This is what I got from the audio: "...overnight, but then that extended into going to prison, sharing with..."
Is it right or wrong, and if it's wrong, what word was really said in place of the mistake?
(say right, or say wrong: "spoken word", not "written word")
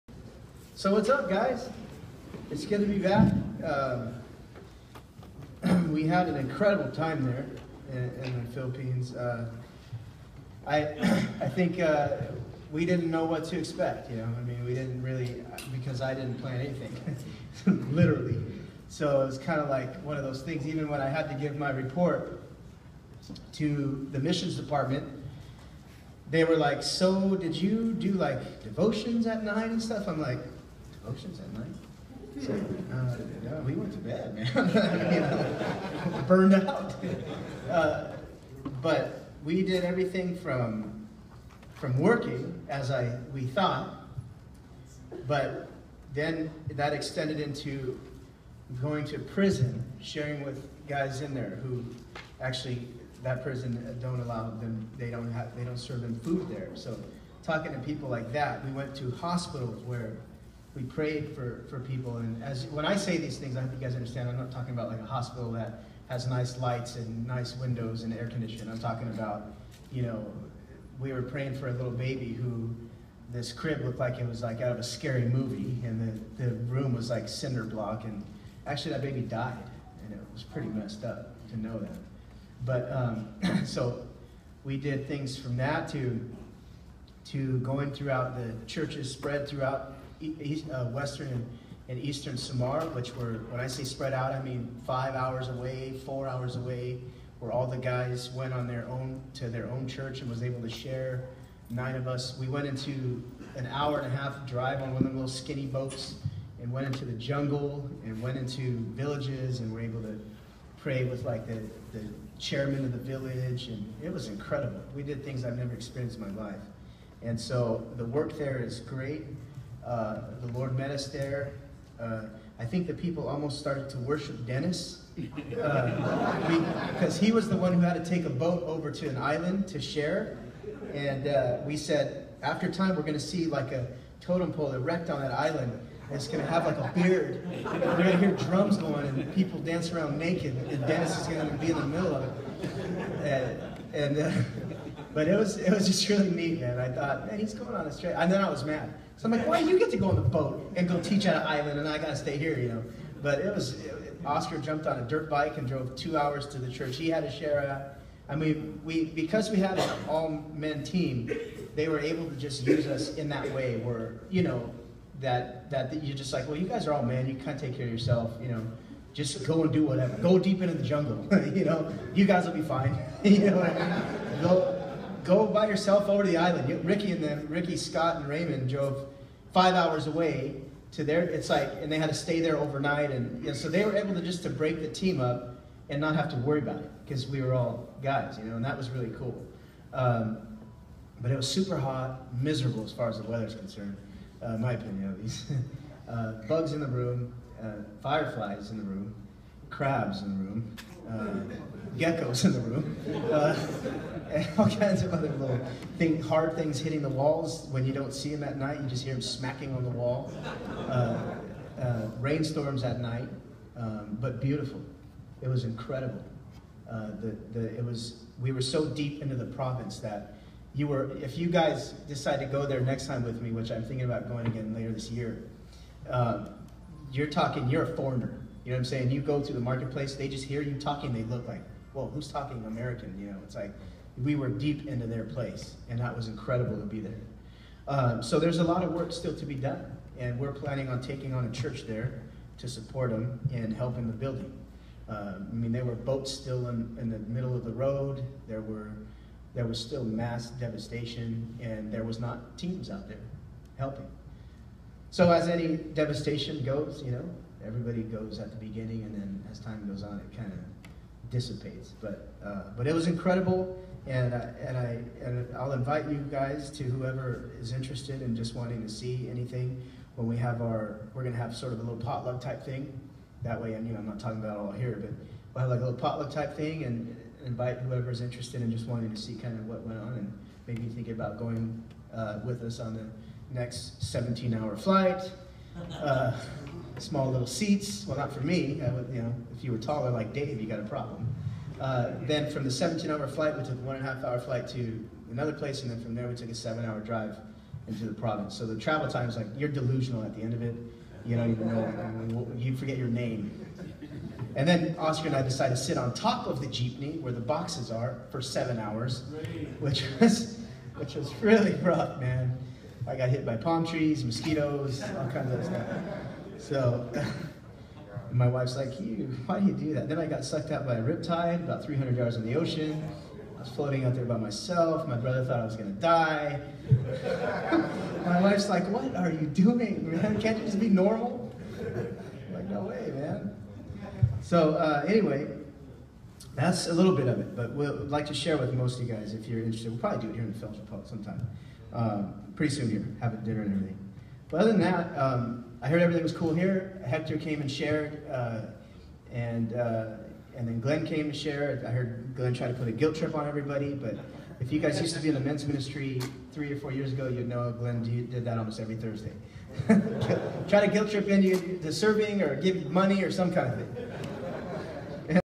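wrong: "thought", not "overnight".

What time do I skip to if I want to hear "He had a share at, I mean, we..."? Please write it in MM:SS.
02:36.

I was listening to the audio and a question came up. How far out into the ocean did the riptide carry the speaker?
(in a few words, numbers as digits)
300 yards.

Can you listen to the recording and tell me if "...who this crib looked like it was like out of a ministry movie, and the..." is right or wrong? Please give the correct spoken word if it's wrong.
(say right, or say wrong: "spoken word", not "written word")
wrong: "scary", not "ministry".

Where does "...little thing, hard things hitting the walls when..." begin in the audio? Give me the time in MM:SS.
03:25.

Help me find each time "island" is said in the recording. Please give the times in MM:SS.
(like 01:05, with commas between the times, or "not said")
02:09, 02:15, 02:31, 02:56.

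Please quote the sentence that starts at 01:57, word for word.
And so the work there is great.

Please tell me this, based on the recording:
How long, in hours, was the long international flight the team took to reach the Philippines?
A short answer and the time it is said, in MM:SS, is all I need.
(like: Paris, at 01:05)
17, at 04:44.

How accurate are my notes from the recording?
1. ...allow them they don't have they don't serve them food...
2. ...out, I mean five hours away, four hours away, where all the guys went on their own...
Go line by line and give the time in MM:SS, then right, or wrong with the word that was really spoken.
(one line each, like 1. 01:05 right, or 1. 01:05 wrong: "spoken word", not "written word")
1. 00:54 right
2. 01:34 right.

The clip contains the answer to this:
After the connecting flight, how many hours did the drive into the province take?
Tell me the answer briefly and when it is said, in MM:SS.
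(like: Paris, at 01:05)
7, at 04:56.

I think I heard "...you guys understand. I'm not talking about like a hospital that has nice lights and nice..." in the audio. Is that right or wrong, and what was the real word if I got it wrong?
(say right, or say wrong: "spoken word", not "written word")
right.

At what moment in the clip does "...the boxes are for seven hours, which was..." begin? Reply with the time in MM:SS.
05:07.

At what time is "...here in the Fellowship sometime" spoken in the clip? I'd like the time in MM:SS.
05:40.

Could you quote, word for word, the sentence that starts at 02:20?
And Dennis is going to be in the middle of it.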